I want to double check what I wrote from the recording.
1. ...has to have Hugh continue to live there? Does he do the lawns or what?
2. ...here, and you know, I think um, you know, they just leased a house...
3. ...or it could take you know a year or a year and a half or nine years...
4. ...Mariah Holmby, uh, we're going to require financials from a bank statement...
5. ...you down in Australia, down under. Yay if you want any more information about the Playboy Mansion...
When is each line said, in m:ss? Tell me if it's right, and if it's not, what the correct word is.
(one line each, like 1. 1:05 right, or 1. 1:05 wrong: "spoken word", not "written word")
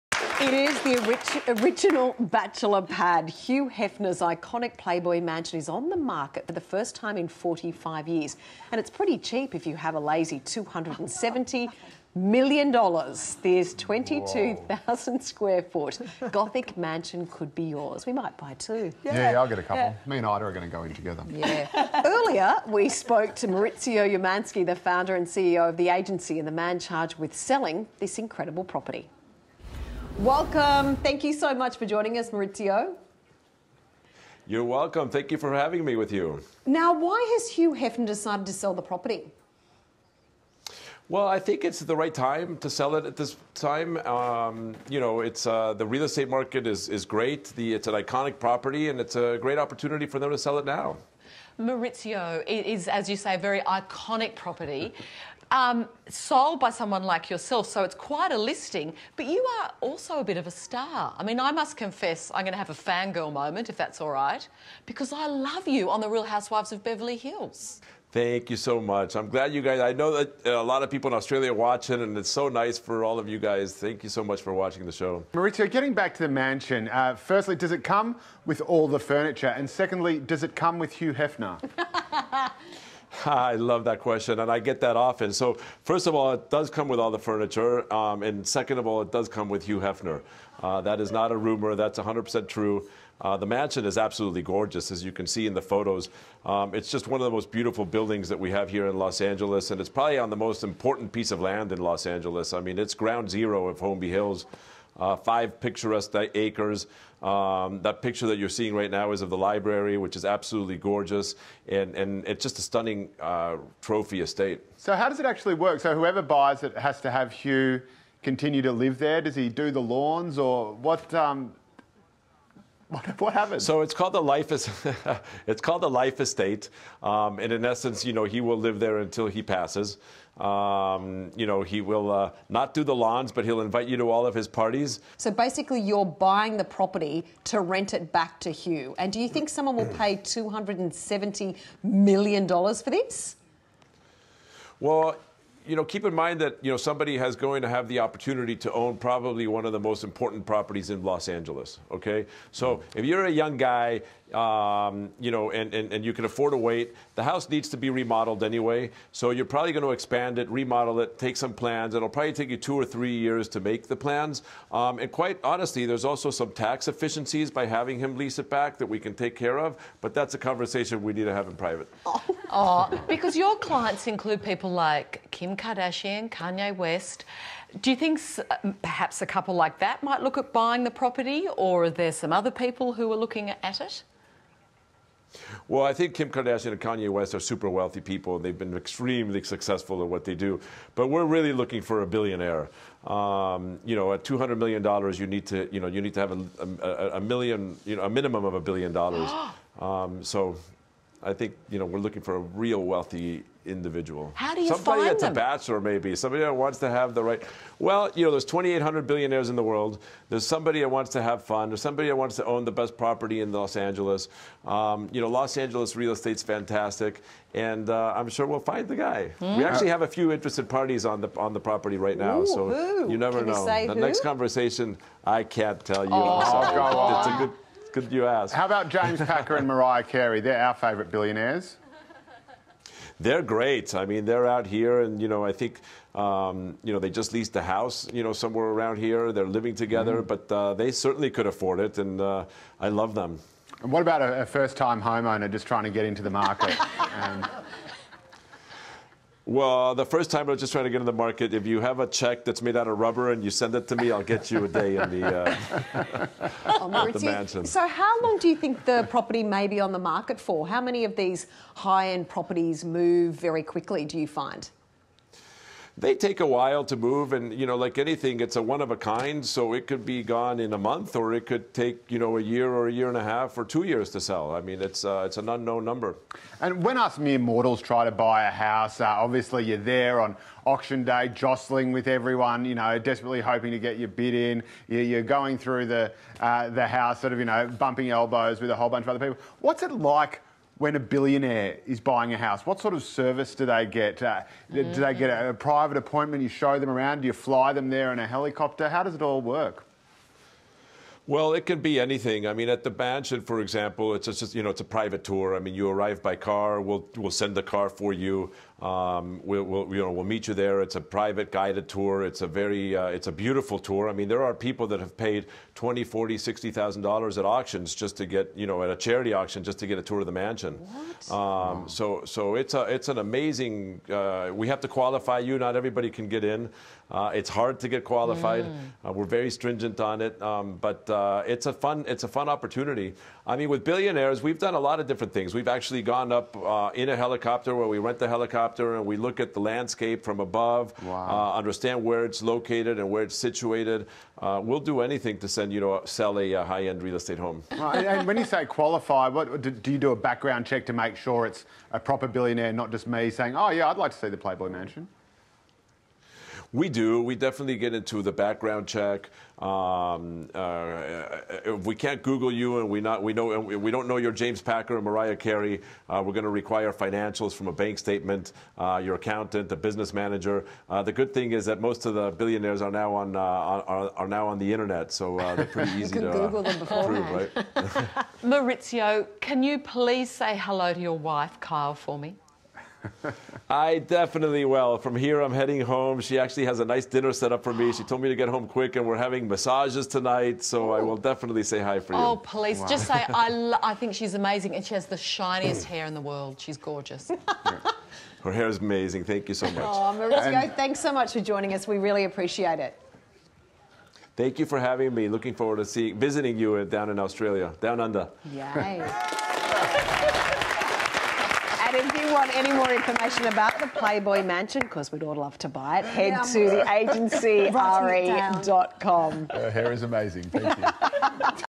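1. 1:56 right
2. 3:54 right
3. 4:31 wrong: "two", not "nine"
4. 6:05 wrong: "Carey", not "Holmby"
5. 6:46 right.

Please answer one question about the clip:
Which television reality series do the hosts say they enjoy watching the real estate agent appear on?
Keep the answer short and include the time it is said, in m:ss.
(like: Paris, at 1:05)
The Real Housewives of Beverly Hills, at 1:05.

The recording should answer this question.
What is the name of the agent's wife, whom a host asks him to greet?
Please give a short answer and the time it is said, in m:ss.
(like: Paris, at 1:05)
Kyle, at 6:21.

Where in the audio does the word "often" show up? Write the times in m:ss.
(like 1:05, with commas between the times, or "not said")
1:24.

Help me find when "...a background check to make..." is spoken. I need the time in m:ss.
5:50.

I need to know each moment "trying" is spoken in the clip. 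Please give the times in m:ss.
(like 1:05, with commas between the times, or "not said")
4:05, 4:10.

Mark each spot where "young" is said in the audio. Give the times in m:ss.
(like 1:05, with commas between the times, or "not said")
2:33.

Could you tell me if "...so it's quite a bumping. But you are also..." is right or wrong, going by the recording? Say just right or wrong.
wrong.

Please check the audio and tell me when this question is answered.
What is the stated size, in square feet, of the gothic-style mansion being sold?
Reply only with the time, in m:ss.
0:13.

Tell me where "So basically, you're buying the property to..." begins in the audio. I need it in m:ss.
2:15.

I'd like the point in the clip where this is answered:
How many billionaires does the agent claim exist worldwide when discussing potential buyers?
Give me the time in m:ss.
3:28.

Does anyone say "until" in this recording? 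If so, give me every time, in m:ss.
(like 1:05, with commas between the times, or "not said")
2:08.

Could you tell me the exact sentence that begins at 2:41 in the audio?
It'll probably take you two or three years to make the plans.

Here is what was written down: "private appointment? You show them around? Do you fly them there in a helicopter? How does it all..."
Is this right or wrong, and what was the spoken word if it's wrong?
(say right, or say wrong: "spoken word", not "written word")
right.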